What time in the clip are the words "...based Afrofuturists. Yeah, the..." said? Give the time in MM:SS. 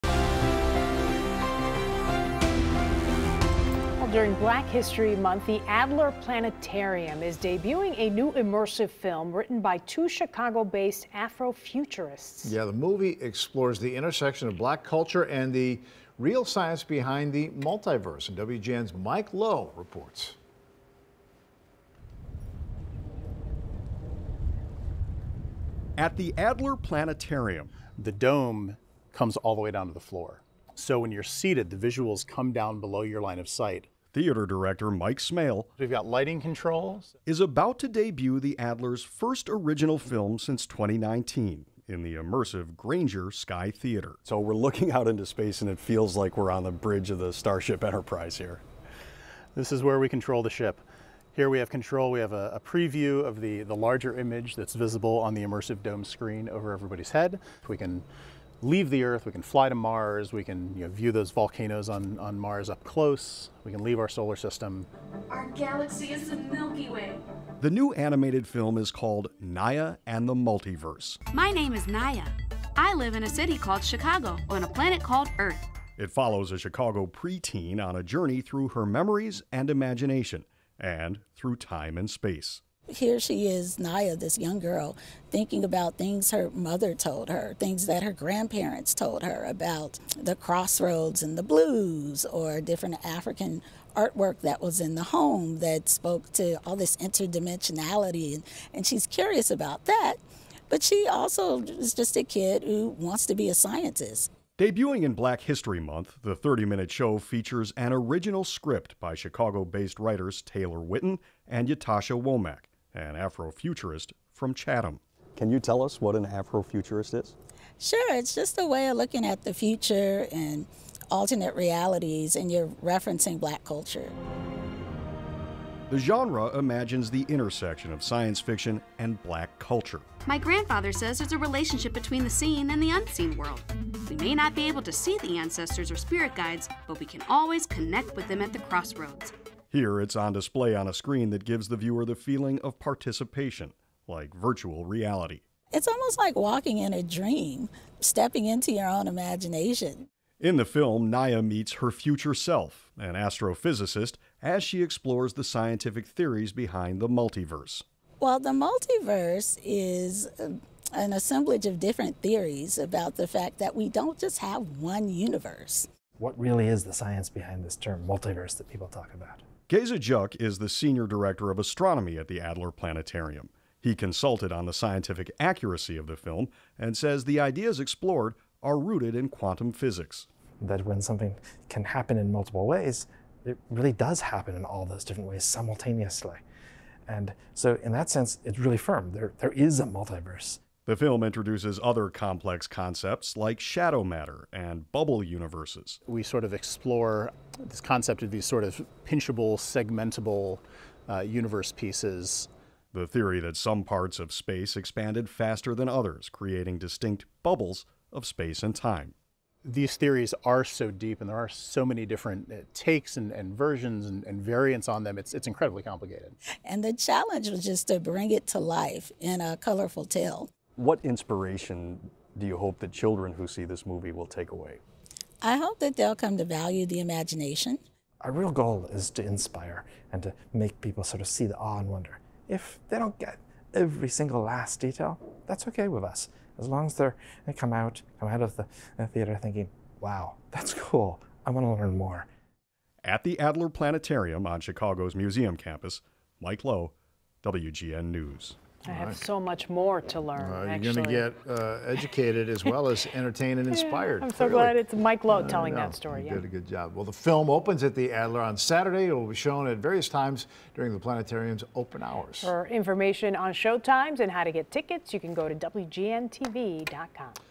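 00:10.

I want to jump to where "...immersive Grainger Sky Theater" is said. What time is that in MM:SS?
00:42.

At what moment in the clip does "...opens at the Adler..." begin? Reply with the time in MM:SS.
04:17.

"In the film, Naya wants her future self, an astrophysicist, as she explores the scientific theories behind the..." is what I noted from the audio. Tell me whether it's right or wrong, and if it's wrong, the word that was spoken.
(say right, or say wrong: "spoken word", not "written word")
wrong: "meets", not "wants".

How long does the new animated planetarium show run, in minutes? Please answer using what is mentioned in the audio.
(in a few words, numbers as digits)
30 minutes.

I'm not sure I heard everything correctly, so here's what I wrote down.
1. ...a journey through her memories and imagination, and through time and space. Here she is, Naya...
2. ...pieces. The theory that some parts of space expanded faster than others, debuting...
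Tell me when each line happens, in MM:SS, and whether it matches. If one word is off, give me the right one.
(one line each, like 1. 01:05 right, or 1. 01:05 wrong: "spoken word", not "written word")
1. 01:17 right
2. 03:21 wrong: "creating", not "debuting".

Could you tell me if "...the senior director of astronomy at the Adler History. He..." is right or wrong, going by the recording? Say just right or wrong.
wrong.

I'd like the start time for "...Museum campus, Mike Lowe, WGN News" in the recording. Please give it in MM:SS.
04:05.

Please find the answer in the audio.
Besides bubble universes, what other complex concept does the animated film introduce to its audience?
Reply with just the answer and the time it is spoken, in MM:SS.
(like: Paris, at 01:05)
Shadow matter, at 03:13.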